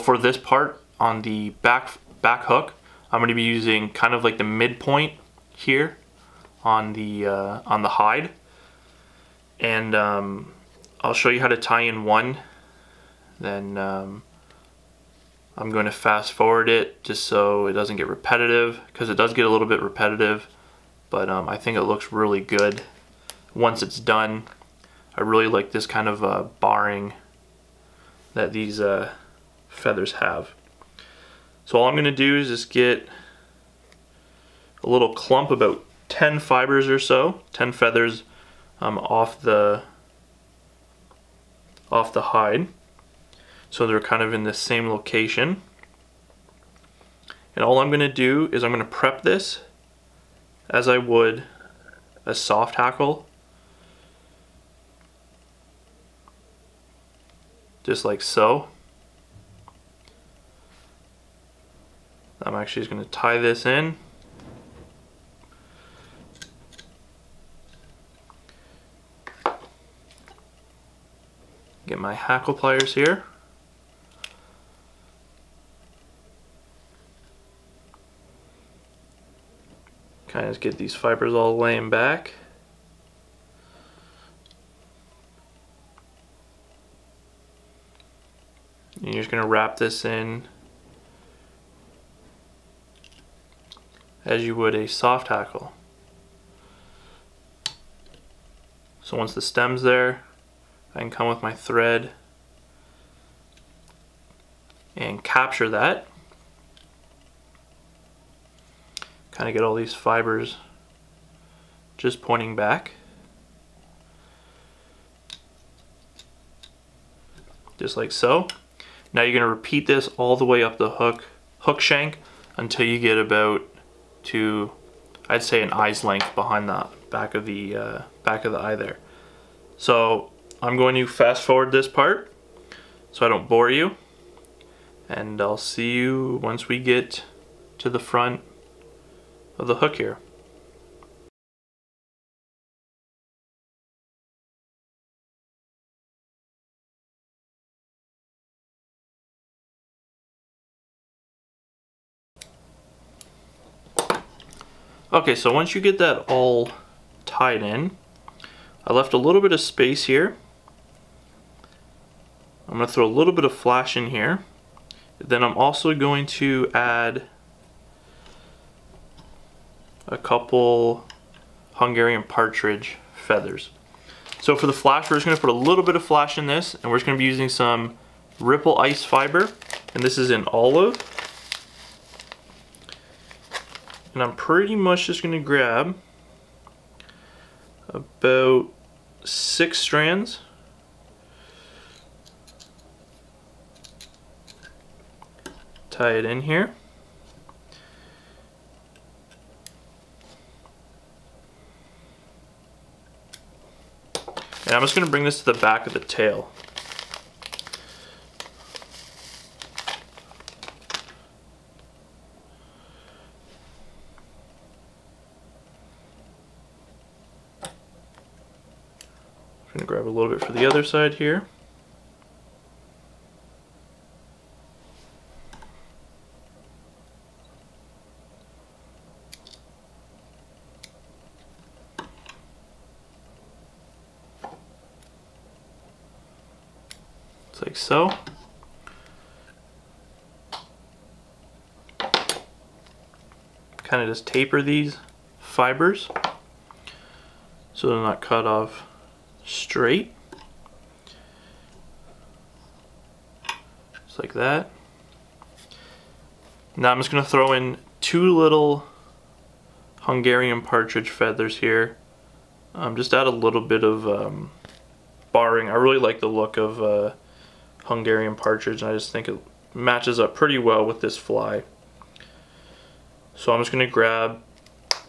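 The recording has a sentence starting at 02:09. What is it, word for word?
So I'm going to fast forward this part so I don't bore you.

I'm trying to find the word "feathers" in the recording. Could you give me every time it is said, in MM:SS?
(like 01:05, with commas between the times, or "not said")
00:29, 00:37, 02:53, 04:21.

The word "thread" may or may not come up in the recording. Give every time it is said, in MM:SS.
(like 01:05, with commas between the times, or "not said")
01:41.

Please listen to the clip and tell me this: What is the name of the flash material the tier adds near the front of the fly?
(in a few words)
Ripple Ice Fiber.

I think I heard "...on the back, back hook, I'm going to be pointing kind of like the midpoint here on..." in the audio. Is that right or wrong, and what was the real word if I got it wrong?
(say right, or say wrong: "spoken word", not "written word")
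wrong: "using", not "pointing".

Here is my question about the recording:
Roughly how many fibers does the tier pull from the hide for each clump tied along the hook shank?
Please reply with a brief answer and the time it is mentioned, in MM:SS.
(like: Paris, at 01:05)
10, at 00:36.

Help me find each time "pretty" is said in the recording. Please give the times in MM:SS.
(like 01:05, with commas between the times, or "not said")
03:04, 04:30.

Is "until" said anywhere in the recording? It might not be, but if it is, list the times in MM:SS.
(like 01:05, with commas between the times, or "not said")
02:02.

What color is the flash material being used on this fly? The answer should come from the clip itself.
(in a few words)
Olive.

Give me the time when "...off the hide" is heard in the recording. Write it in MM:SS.
00:41.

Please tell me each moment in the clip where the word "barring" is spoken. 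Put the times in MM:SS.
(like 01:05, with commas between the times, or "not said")
00:26, 04:25.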